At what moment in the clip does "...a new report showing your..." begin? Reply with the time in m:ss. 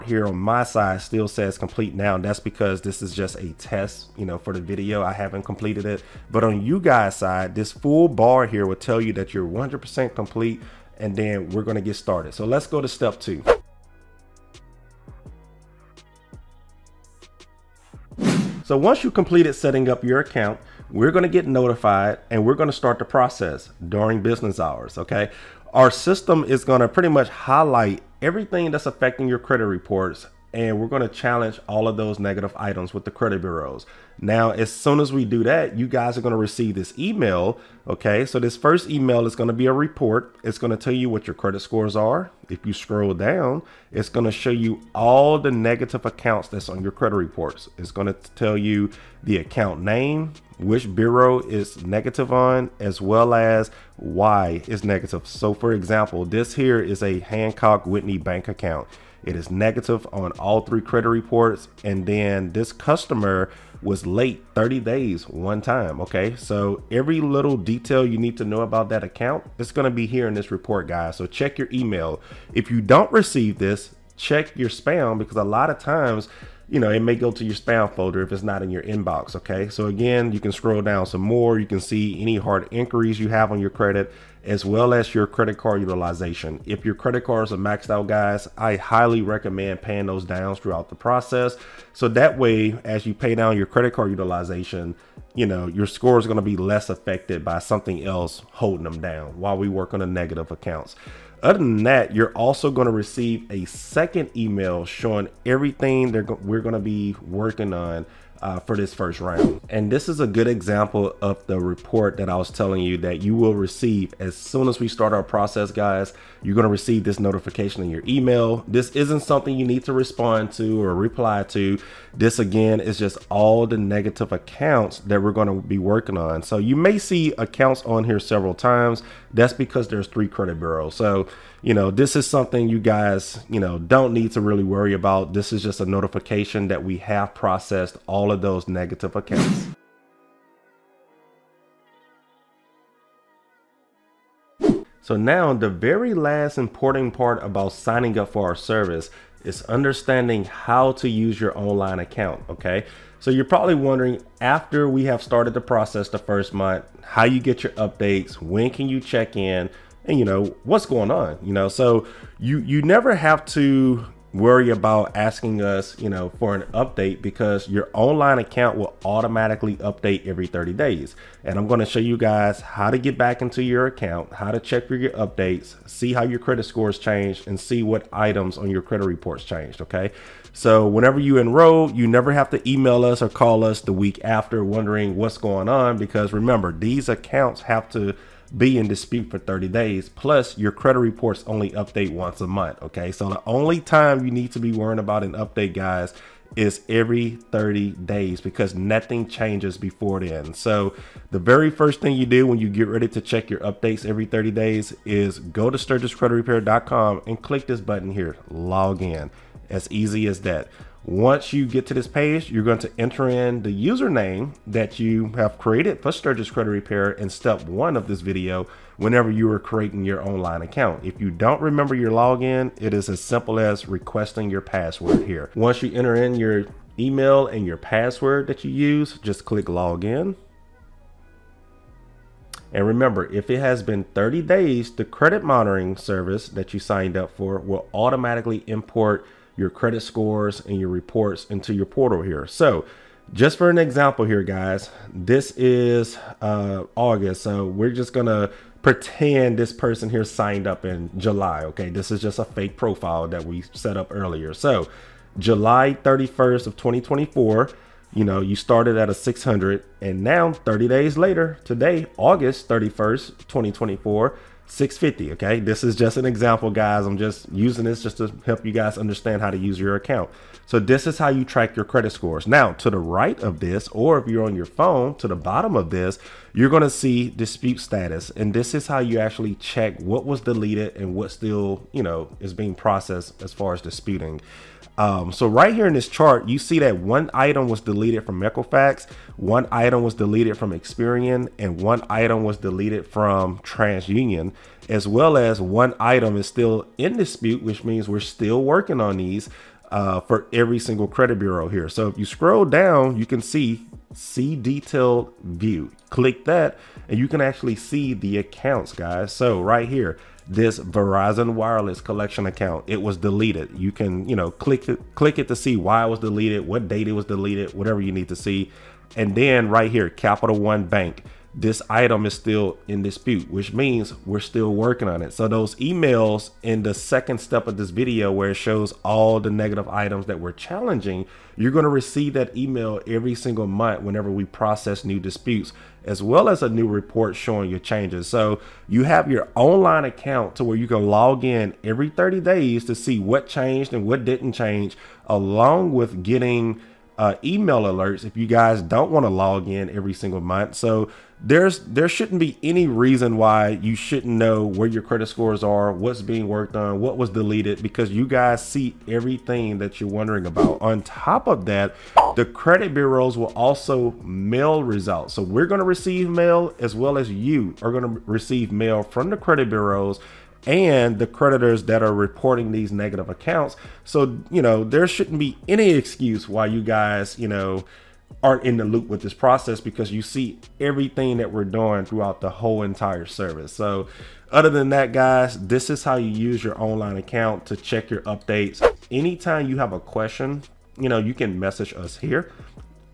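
5:36.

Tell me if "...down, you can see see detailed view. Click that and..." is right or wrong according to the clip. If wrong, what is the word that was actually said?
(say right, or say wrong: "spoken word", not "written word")
right.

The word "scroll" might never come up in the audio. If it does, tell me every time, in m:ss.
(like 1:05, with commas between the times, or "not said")
0:42, 1:20, 5:02.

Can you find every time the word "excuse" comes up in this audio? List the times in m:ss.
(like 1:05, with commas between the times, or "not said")
6:15.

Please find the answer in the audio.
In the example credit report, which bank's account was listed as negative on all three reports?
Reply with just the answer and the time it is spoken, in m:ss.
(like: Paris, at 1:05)
Hancock Whitney, at 0:57.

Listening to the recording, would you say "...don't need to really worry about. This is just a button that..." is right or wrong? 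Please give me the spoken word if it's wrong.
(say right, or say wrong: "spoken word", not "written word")
wrong: "notification", not "button".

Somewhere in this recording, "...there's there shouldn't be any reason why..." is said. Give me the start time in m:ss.
5:51.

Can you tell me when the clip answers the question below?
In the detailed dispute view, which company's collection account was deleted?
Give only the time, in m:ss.
5:10.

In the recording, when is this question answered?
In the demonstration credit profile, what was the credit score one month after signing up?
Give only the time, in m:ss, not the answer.
4:24.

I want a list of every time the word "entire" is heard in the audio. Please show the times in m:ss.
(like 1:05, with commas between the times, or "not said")
6:22.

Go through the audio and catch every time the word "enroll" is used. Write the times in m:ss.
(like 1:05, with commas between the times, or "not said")
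3:01.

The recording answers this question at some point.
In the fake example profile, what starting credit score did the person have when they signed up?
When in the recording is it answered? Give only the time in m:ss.
4:19.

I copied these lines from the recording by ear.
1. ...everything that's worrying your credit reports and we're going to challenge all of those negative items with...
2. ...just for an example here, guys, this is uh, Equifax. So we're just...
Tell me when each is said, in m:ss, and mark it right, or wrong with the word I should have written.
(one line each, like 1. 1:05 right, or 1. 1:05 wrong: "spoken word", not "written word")
1. 0:28 wrong: "affecting", not "worrying"
2. 4:03 wrong: "August", not "Equifax".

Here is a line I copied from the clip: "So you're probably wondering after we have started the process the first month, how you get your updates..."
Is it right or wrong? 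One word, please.
right.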